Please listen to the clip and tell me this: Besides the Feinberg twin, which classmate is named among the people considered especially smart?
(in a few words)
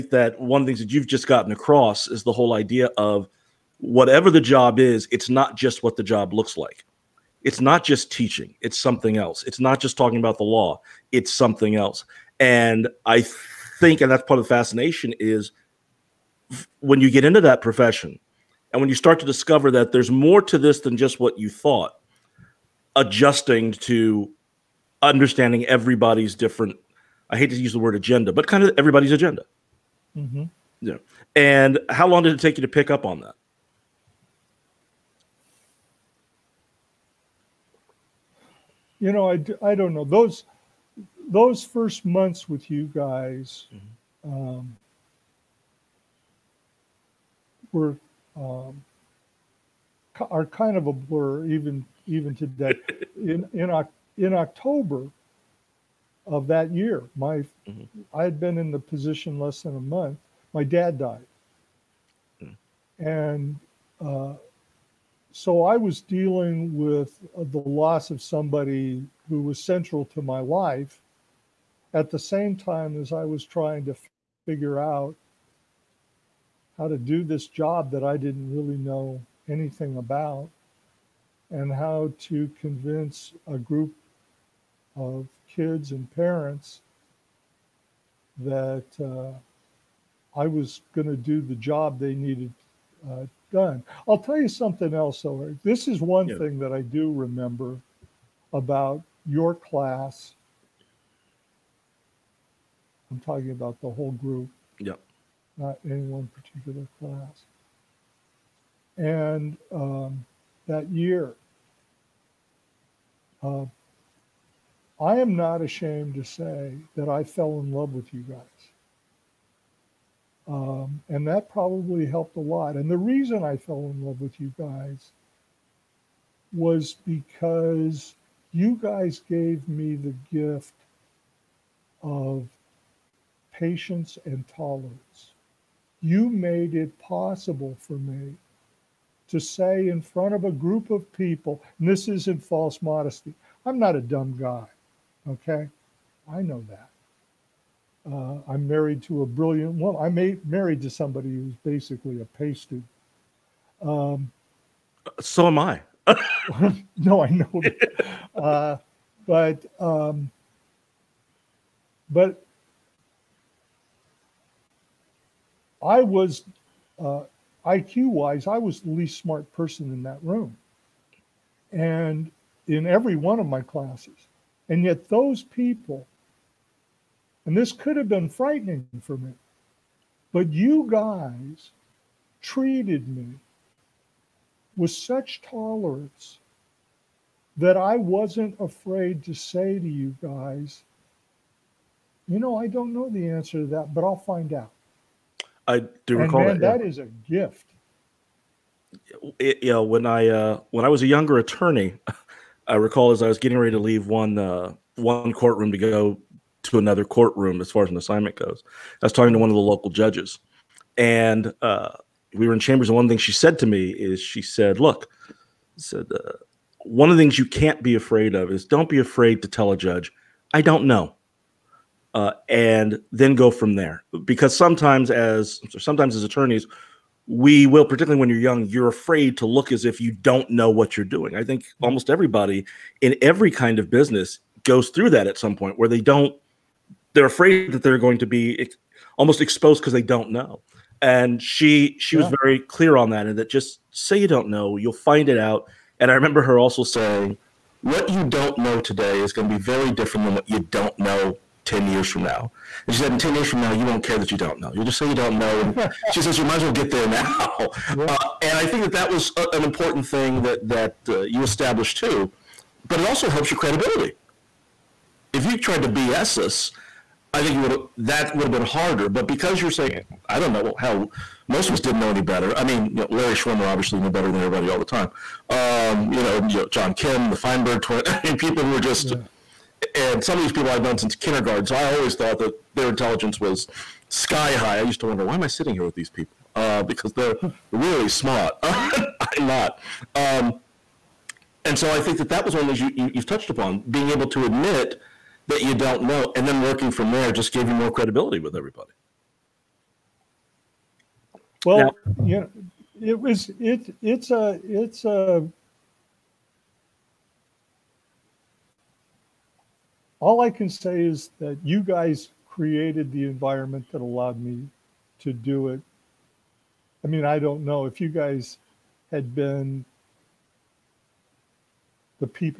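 John Kim.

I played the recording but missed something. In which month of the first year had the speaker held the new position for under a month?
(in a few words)
October.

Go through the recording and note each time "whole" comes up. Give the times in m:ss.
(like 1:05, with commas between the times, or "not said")
0:02, 1:43.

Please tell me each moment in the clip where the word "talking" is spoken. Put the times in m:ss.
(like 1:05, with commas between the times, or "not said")
0:09, 1:43, 3:29.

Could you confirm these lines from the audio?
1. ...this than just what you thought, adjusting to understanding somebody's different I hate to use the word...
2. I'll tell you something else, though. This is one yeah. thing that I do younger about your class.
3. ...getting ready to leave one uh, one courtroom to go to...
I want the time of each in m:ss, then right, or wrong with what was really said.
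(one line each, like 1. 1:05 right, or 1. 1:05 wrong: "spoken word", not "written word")
1. 0:20 wrong: "everybody", not "somebody"
2. 1:34 wrong: "remember", not "younger"
3. 3:23 right.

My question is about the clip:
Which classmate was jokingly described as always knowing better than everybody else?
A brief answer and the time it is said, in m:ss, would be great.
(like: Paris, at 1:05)
Larry Schwimmer, at 4:33.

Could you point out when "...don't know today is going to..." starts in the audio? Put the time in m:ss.
4:08.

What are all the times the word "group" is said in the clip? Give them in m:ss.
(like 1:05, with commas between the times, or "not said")
1:23, 1:44, 2:20.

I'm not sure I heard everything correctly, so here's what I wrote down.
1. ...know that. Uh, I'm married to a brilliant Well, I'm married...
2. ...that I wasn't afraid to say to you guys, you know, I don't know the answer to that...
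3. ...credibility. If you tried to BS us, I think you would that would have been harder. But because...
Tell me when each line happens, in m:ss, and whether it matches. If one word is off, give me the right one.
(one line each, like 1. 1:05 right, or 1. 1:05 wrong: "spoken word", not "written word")
1. 2:26 right
2. 3:07 right
3. 4:23 right.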